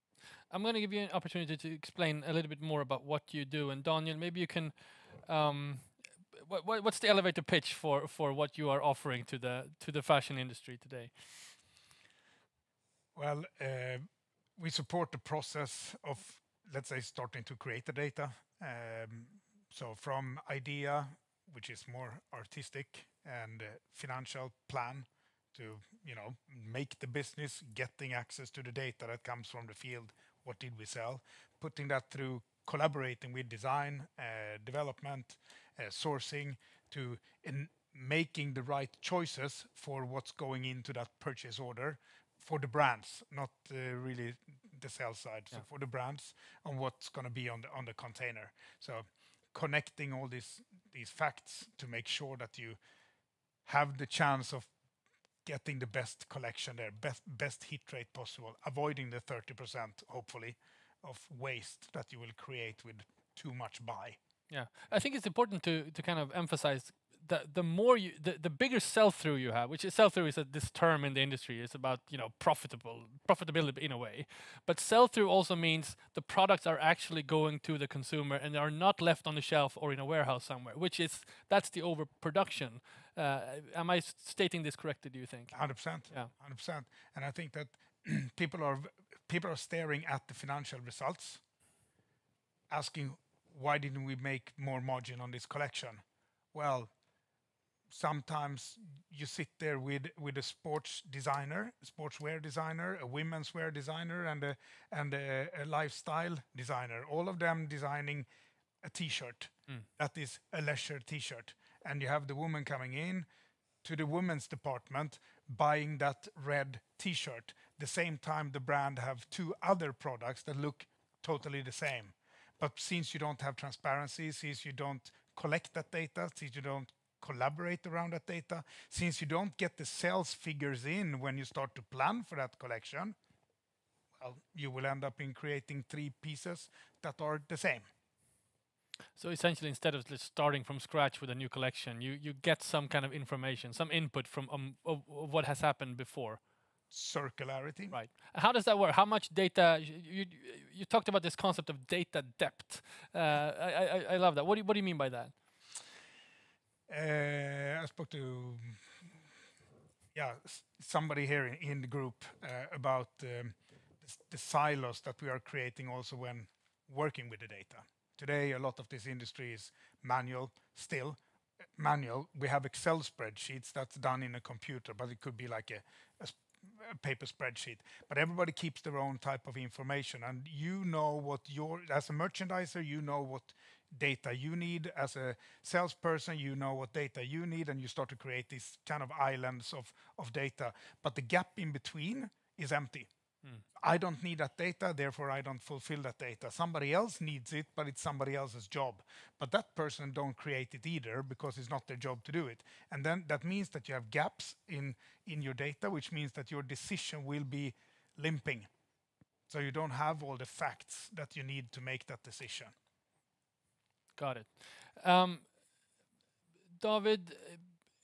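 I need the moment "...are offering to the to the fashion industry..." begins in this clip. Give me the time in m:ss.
0:08.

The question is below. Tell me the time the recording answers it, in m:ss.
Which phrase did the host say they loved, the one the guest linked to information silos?
2:31.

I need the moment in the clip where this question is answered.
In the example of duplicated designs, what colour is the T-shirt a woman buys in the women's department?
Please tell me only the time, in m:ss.
1:56.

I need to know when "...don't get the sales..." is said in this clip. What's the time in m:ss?
2:09.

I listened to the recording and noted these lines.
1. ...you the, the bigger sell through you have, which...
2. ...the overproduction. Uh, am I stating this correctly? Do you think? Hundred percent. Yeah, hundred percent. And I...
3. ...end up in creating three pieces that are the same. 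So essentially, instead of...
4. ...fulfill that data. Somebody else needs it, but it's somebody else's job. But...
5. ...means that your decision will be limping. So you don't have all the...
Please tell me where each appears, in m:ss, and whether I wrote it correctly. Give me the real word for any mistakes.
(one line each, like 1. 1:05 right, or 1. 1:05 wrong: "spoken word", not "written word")
1. 1:07 right
2. 1:21 right
3. 2:14 right
4. 3:15 right
5. 3:26 right.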